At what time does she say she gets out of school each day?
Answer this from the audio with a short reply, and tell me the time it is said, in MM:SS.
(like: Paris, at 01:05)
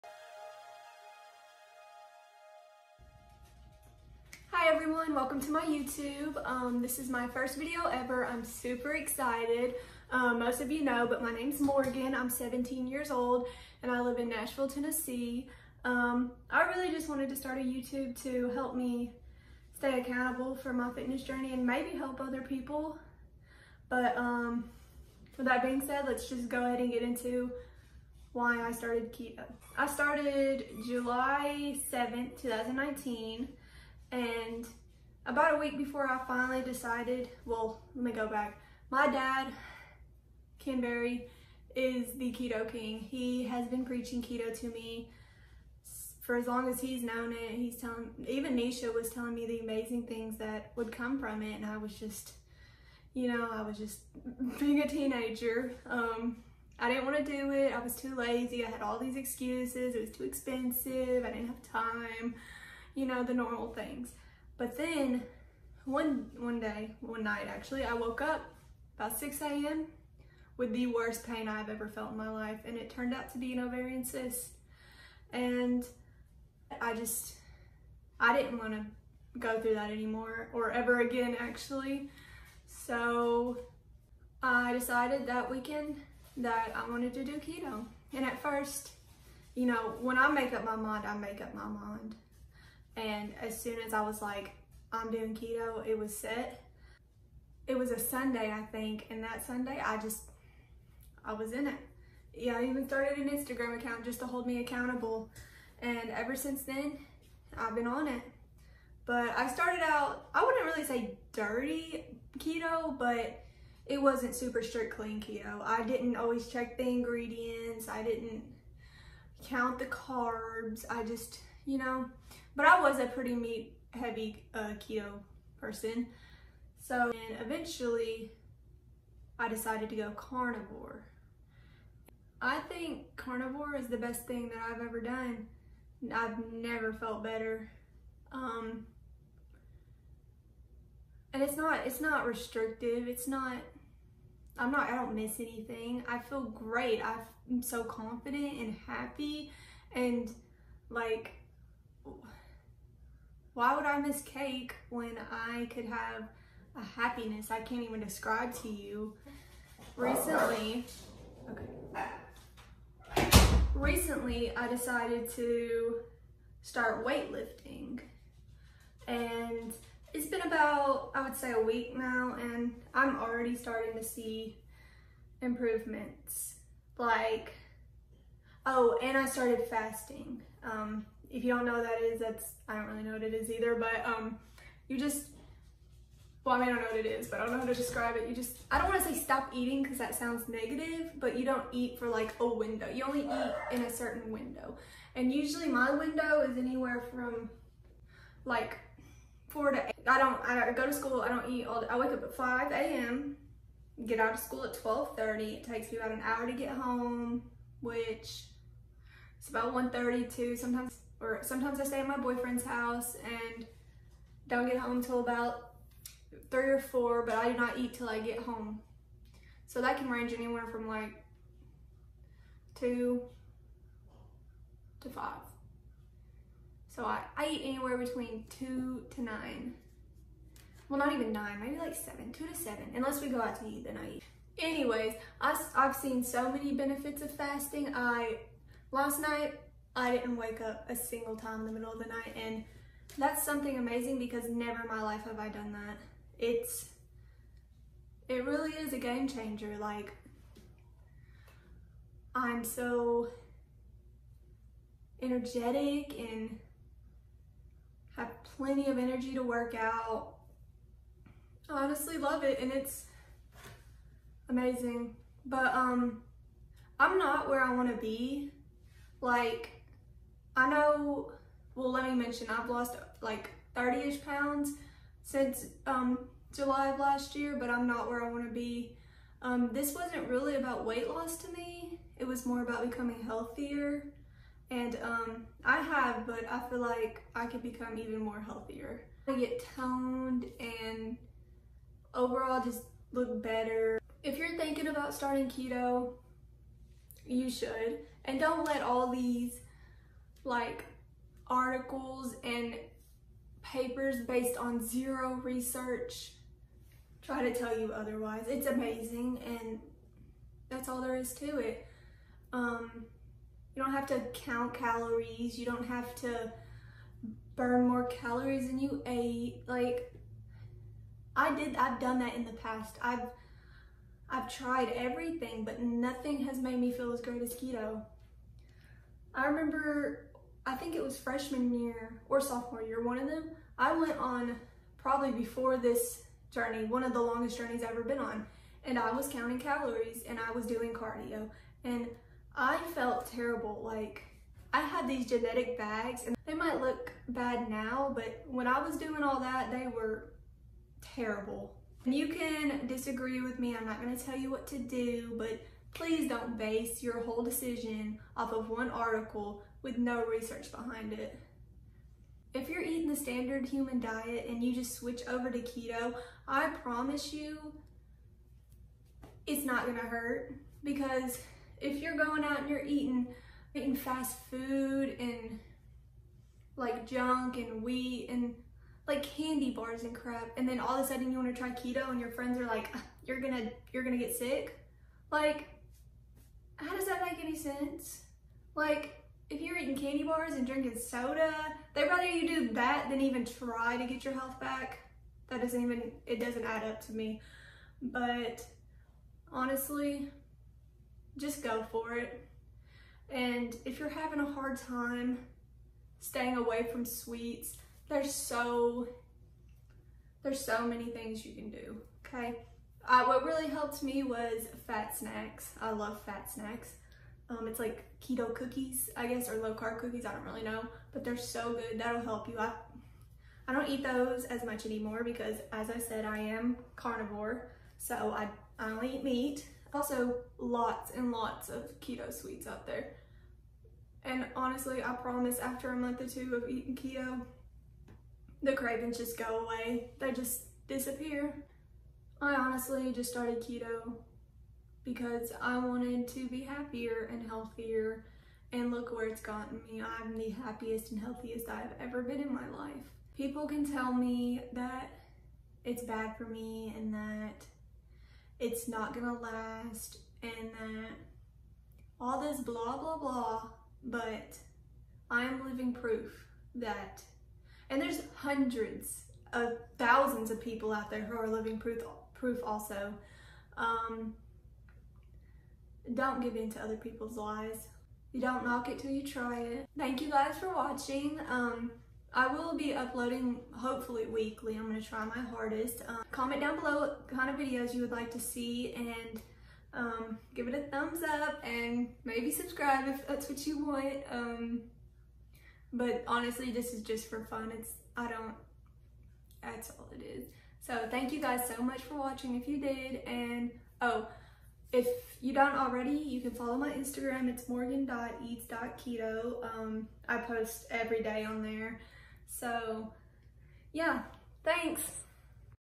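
12:30, at 03:24.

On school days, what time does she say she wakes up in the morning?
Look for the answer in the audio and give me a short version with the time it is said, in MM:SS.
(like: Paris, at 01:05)
5 a.m., at 03:22.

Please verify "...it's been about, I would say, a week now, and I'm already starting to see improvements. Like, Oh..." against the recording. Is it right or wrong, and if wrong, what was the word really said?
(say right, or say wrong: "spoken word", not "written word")
right.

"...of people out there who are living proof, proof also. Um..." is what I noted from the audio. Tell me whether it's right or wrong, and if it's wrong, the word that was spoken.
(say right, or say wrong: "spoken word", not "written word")
right.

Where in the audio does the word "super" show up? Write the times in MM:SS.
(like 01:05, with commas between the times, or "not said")
00:08, 01:54.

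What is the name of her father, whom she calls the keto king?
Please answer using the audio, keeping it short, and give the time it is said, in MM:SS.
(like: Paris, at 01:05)
Ken Berry, at 00:40.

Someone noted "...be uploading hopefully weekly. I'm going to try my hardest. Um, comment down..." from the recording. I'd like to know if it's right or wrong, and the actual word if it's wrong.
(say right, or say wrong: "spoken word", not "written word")
right.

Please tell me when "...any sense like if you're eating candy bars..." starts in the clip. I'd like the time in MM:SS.
06:27.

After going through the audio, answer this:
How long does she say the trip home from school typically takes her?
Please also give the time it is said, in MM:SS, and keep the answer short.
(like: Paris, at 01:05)
About an hour, at 03:25.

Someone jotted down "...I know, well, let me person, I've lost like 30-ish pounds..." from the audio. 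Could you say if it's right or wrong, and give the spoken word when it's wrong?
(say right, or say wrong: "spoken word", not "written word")
wrong: "mention", not "person".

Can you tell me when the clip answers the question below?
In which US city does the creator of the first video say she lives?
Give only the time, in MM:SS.
00:14.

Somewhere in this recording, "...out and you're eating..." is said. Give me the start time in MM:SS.
06:12.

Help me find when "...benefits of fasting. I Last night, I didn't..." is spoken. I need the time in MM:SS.
03:56.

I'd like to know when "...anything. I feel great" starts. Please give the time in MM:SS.
02:25.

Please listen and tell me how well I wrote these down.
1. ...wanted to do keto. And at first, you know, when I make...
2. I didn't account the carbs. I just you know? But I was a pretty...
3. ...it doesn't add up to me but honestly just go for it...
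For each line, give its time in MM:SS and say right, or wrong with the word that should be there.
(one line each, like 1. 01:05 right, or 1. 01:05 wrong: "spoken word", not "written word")
1. 01:26 right
2. 01:57 wrong: "count", not "account"
3. 06:36 right.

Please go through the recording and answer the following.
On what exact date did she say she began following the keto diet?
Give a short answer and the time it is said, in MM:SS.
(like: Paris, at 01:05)
July 7, 2019, at 00:30.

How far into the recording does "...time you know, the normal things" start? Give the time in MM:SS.
01:01.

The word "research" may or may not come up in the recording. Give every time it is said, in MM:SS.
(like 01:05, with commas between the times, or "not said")
05:05, 06:00.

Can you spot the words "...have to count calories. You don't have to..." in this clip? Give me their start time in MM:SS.
05:13.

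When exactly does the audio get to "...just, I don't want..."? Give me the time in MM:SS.
03:08.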